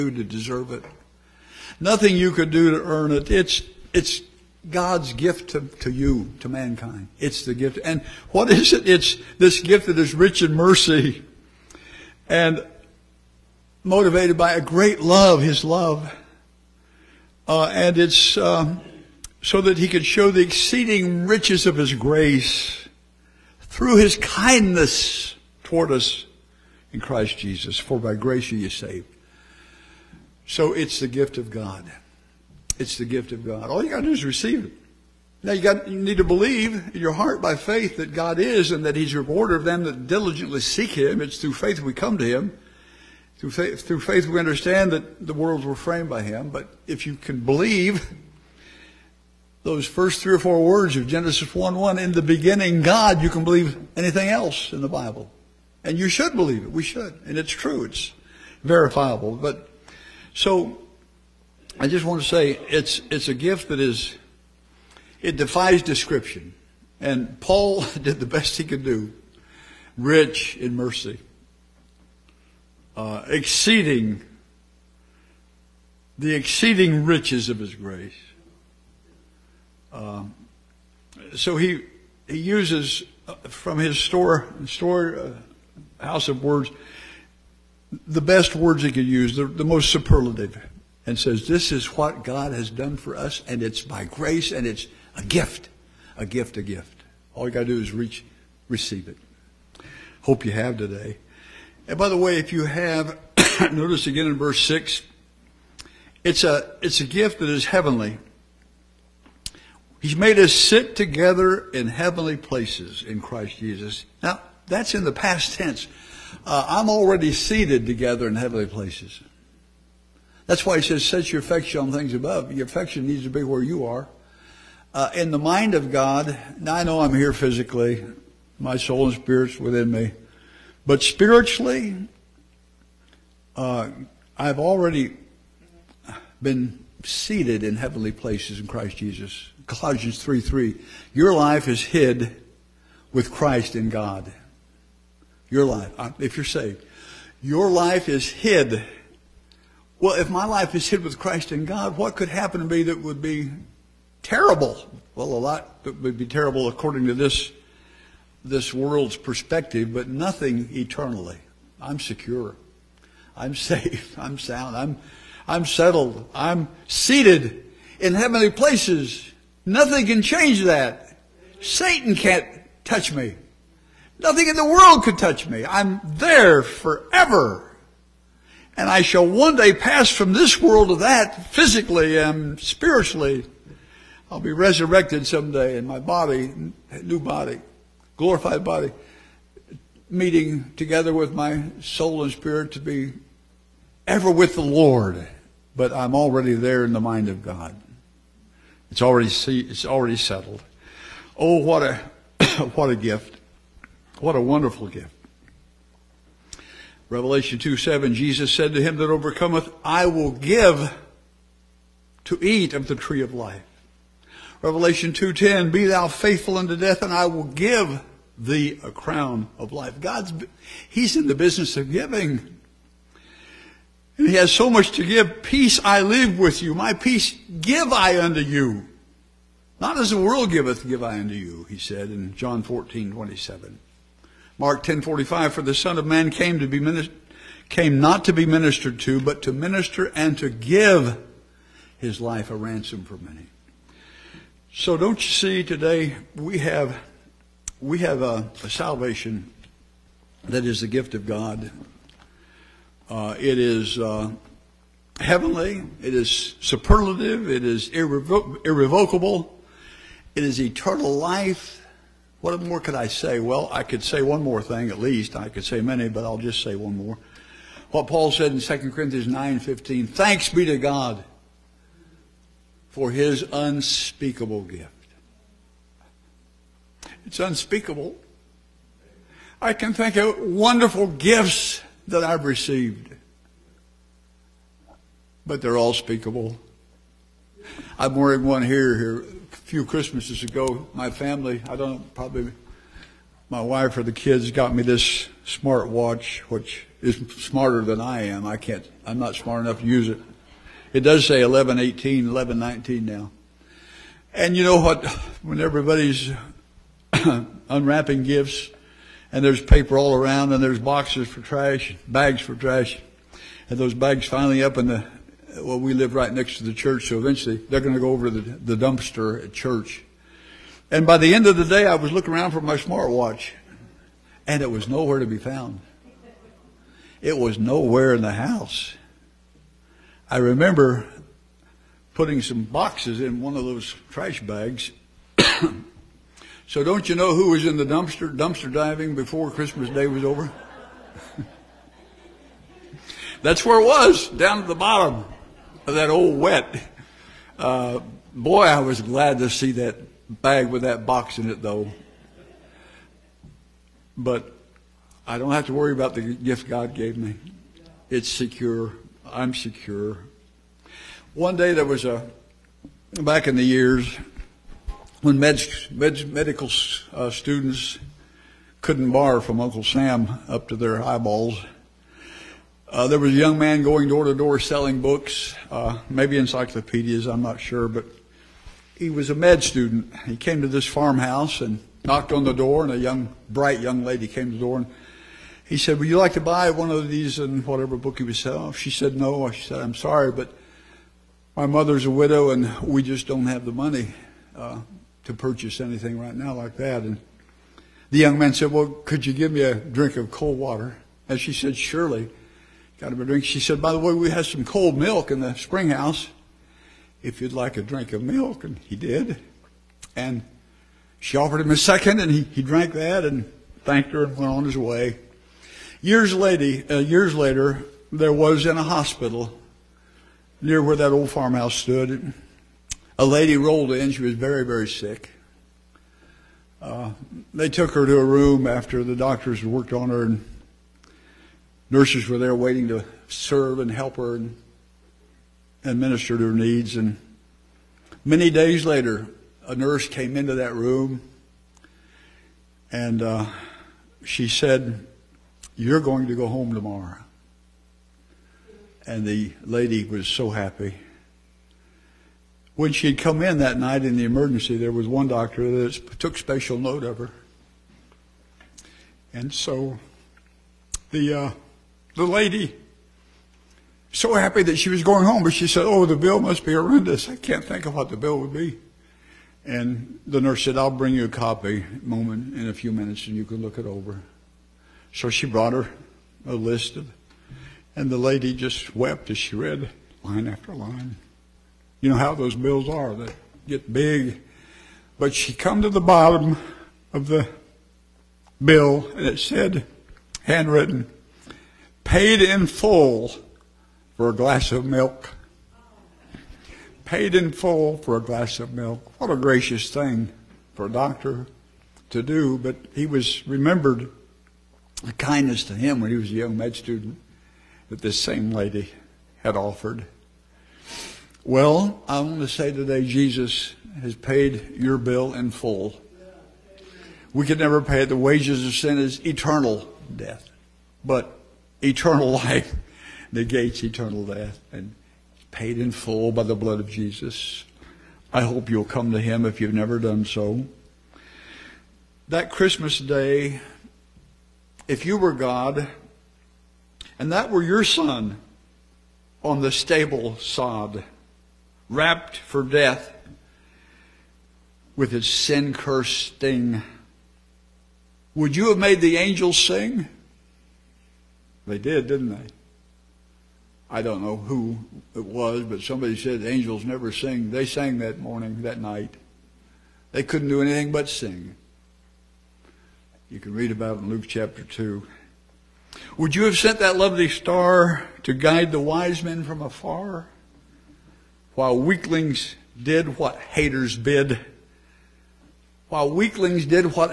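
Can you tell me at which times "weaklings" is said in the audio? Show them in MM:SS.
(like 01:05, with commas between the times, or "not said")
09:31, 09:36.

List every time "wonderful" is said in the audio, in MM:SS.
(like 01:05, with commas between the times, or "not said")
03:24, 04:40.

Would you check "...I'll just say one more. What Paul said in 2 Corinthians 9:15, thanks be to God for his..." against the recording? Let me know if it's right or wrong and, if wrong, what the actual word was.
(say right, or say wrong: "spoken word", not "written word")
right.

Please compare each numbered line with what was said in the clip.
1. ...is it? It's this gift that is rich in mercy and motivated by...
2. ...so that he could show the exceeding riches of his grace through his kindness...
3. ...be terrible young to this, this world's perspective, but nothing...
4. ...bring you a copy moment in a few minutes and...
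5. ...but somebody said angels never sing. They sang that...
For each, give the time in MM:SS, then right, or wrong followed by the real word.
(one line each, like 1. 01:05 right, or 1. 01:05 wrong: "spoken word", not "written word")
1. 00:08 right
2. 00:19 right
3. 02:36 wrong: "according", not "young"
4. 07:50 right
5. 09:15 right.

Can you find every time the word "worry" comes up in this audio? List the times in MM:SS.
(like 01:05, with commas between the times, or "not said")
05:55.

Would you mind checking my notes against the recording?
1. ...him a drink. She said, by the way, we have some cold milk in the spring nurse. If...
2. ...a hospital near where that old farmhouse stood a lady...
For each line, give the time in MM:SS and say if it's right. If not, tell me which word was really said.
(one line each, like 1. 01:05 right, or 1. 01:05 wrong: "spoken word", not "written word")
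1. 06:43 wrong: "house", not "nurse"
2. 06:58 right.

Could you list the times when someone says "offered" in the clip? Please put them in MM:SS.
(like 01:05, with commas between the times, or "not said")
06:51, 08:29.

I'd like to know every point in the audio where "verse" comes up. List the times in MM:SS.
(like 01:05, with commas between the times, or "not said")
01:44.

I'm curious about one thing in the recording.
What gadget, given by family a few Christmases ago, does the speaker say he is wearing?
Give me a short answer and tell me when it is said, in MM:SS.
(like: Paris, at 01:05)
smart watch, at 04:55.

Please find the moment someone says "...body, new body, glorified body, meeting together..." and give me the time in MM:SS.
03:05.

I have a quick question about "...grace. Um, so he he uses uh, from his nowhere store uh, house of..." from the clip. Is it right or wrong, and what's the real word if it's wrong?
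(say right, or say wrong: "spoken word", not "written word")
wrong: "store", not "nowhere".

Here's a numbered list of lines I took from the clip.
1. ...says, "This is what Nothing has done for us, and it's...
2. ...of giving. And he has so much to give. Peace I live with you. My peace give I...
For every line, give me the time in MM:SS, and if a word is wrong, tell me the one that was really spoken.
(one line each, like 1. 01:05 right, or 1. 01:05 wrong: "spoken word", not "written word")
1. 01:31 wrong: "God", not "Nothing"
2. 03:41 right.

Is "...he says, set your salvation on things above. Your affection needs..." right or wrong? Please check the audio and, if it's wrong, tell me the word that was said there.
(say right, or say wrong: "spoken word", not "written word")
wrong: "affection", not "salvation".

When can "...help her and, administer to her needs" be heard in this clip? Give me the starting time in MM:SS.
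07:13.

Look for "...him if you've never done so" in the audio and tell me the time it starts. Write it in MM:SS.
08:49.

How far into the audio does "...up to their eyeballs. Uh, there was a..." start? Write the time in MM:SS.
06:10.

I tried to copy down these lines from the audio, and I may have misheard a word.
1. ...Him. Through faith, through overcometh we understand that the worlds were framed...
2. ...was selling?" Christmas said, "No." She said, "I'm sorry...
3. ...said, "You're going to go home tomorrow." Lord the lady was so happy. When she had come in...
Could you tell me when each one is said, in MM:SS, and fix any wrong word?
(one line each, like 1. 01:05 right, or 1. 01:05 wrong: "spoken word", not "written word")
1. 00:42 wrong: "faith", not "overcometh"
2. 06:28 wrong: "She", not "Christmas"
3. 07:24 wrong: "And", not "Lord".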